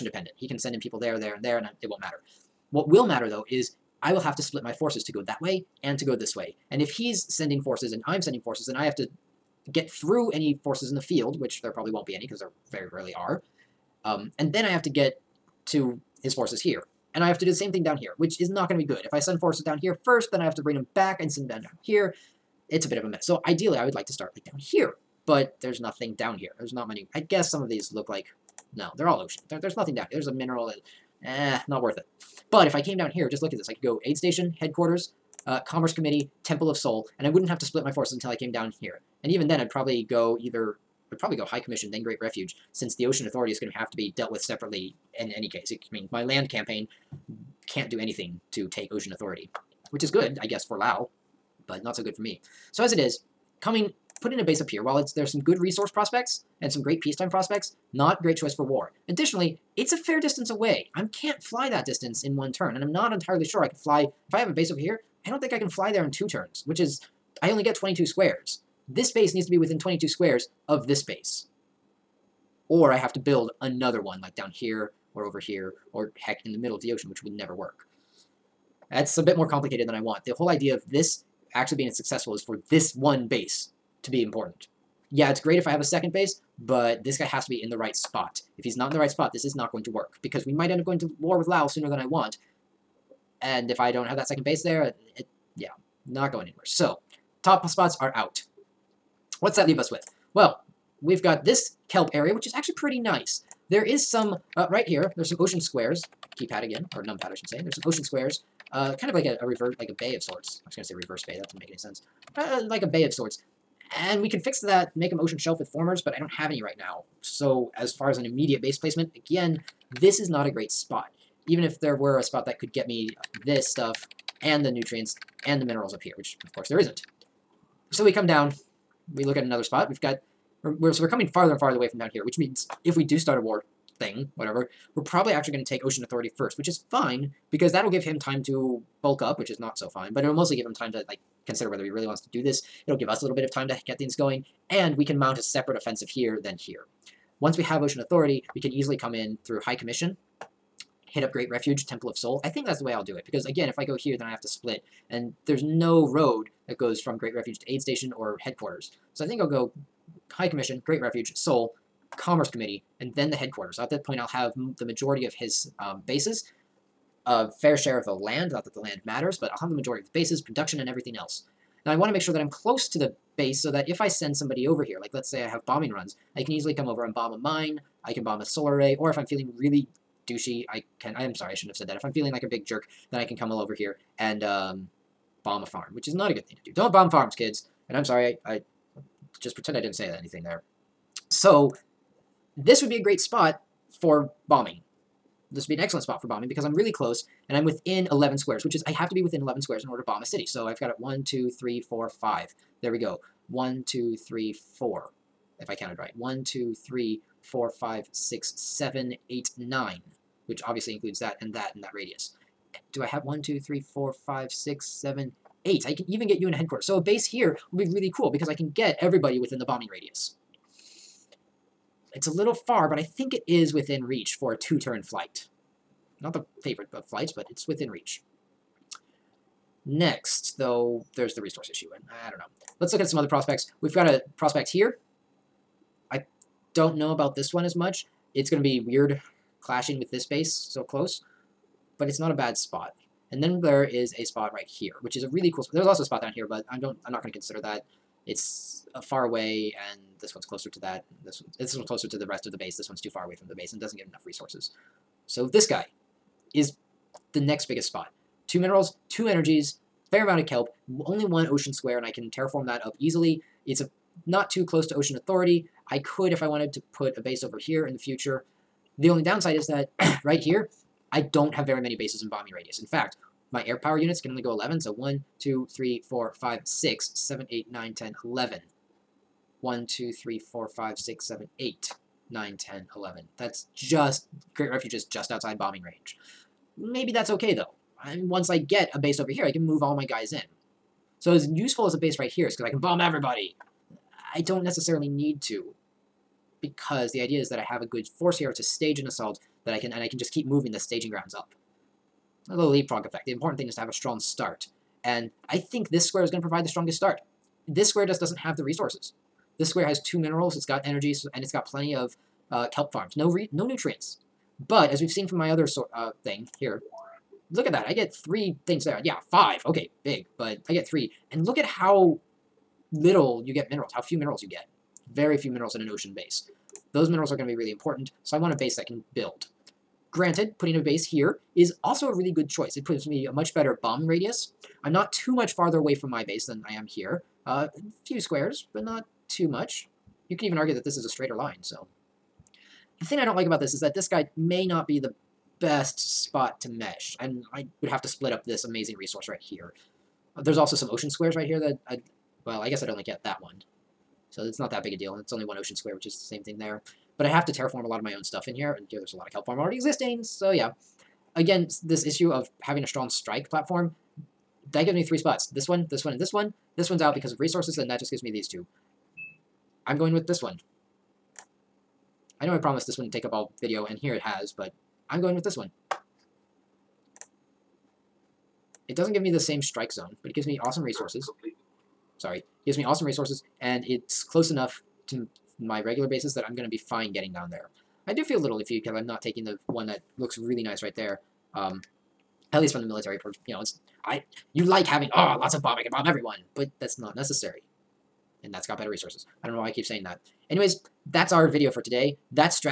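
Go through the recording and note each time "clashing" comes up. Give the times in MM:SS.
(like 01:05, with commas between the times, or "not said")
03:59.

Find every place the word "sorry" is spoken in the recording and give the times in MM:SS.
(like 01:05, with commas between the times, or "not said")
03:01, 03:08, 06:22.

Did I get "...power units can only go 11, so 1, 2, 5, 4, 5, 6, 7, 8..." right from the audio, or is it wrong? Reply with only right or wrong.
wrong.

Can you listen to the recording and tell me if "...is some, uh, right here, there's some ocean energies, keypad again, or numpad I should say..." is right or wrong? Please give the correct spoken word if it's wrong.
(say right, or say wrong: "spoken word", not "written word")
wrong: "squares", not "energies".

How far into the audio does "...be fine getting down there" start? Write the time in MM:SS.
06:26.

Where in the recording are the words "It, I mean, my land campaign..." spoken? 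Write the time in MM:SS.
00:45.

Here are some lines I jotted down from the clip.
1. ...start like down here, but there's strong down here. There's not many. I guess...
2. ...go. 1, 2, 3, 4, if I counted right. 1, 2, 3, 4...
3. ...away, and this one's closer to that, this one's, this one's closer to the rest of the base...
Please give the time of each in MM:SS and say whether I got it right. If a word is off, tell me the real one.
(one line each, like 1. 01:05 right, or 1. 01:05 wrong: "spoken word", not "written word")
1. 00:24 wrong: "nothing", not "strong"
2. 03:22 right
3. 04:09 right.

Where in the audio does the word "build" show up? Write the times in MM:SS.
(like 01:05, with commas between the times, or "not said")
01:13, 05:29.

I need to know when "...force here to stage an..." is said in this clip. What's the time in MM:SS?
04:58.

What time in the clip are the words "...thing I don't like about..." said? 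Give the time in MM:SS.
05:43.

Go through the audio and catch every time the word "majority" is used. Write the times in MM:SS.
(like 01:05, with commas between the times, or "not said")
02:44, 02:49.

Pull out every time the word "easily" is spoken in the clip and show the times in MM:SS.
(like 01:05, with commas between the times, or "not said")
02:28, 02:56, 04:22.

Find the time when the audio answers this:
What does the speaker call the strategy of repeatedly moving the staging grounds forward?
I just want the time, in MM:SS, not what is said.
05:02.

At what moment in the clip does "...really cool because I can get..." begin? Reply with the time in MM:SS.
03:37.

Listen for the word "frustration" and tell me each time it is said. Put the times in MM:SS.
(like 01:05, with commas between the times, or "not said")
not said.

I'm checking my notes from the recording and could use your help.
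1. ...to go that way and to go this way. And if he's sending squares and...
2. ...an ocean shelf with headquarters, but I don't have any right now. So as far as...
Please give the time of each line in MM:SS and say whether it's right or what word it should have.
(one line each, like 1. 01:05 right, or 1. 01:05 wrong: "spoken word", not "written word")
1. 00:05 wrong: "forces", not "squares"
2. 01:55 wrong: "formers", not "headquarters".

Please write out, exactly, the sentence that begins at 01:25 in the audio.
Yeah, it's great if I have a second base, but this guy has to be in the right spot.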